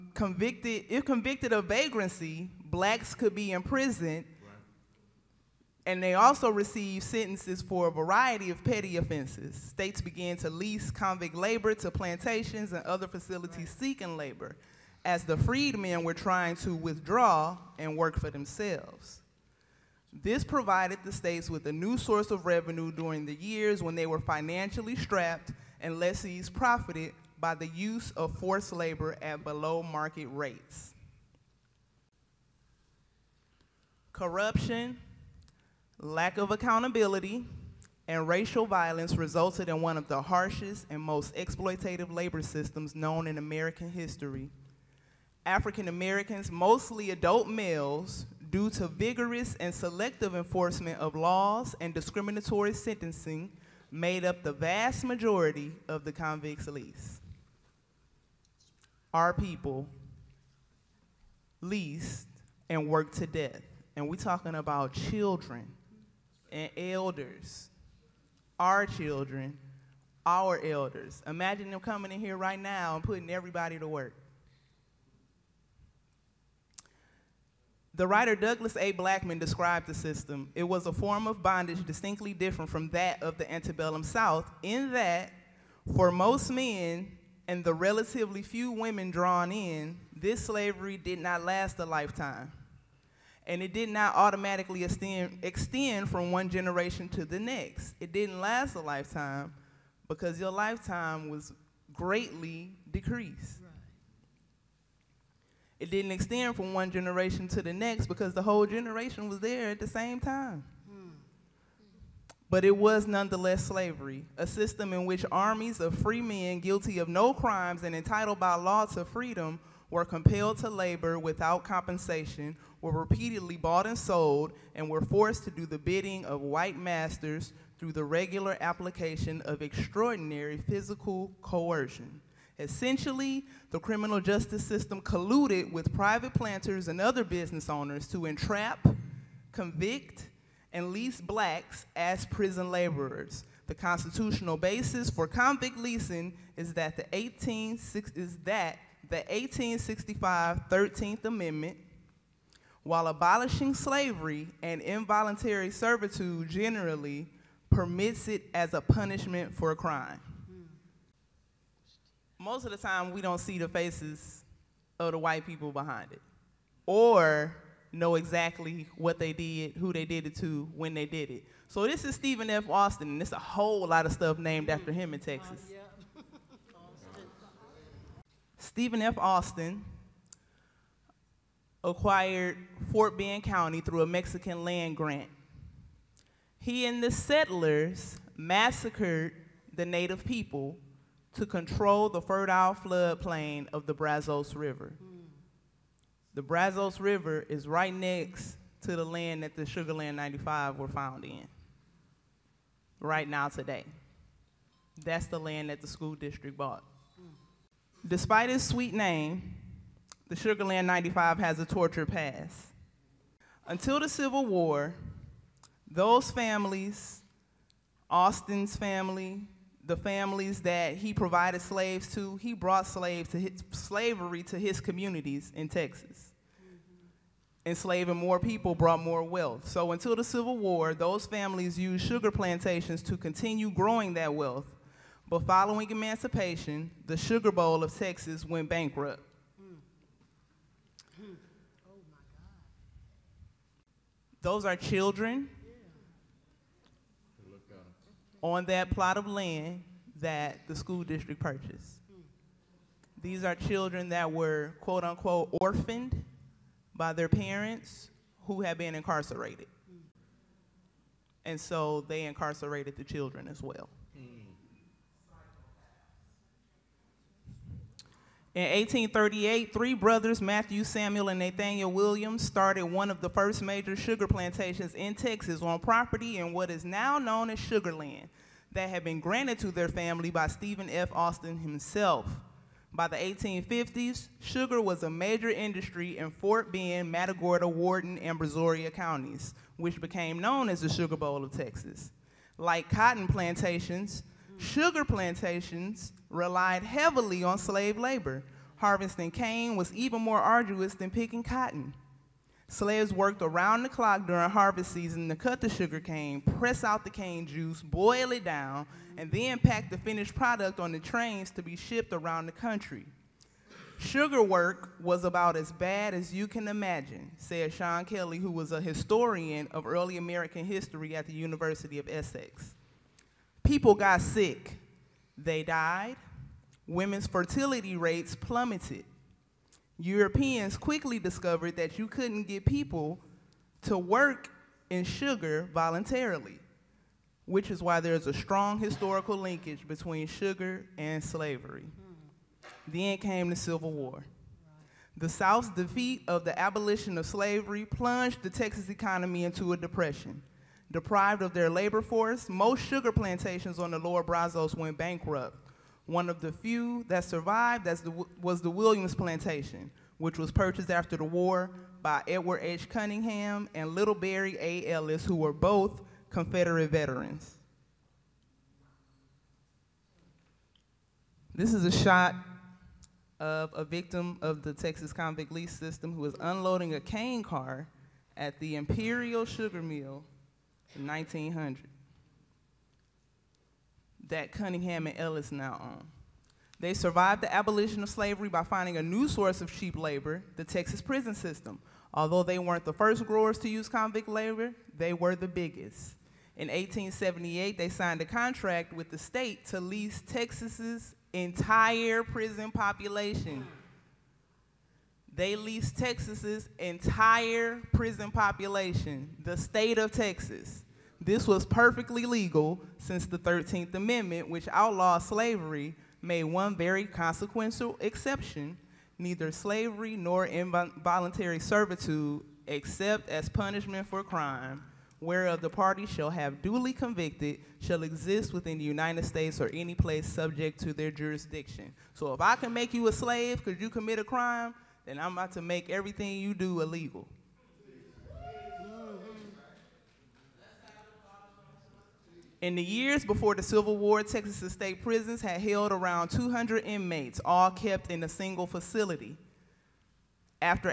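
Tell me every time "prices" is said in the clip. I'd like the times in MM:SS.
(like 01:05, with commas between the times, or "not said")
not said.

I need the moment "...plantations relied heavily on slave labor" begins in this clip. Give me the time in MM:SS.
04:55.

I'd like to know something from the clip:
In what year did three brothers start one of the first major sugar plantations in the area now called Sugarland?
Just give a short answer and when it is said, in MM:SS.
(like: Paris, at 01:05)
1838, at 04:28.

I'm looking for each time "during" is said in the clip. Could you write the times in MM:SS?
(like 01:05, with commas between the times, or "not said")
00:22, 05:04.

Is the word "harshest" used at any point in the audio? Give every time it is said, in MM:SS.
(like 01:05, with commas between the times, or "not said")
00:40.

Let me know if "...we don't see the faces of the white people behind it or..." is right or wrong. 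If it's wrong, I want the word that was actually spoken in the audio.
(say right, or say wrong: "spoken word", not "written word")
right.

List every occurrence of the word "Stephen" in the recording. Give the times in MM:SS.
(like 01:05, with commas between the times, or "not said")
02:52, 02:58, 04:40.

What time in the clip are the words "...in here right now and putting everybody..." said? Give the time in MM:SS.
01:12.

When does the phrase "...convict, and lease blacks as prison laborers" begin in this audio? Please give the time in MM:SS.
02:19.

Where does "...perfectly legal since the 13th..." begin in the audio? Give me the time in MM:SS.
06:51.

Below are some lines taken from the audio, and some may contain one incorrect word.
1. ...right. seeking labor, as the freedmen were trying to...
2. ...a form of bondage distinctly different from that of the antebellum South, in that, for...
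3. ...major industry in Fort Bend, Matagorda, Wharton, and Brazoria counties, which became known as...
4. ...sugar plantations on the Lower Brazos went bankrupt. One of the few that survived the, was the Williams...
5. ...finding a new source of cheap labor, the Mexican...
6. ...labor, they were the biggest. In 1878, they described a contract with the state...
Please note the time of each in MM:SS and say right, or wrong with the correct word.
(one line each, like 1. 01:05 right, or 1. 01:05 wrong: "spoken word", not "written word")
1. 00:13 right
2. 01:20 right
3. 04:45 right
4. 05:52 right
5. 06:28 wrong: "Texas", not "Mexican"
6. 06:34 wrong: "signed", not "described".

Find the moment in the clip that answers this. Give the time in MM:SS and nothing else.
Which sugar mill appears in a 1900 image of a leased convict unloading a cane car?
06:18.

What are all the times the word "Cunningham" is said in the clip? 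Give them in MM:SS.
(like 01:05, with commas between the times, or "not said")
06:02, 06:24.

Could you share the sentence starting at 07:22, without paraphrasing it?
In the years before the Civil War, Texas state prisons had held around 200 inmates, all kept in a single facility.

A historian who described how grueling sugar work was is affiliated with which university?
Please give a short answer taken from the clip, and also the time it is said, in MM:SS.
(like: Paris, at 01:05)
University of Essex, at 05:21.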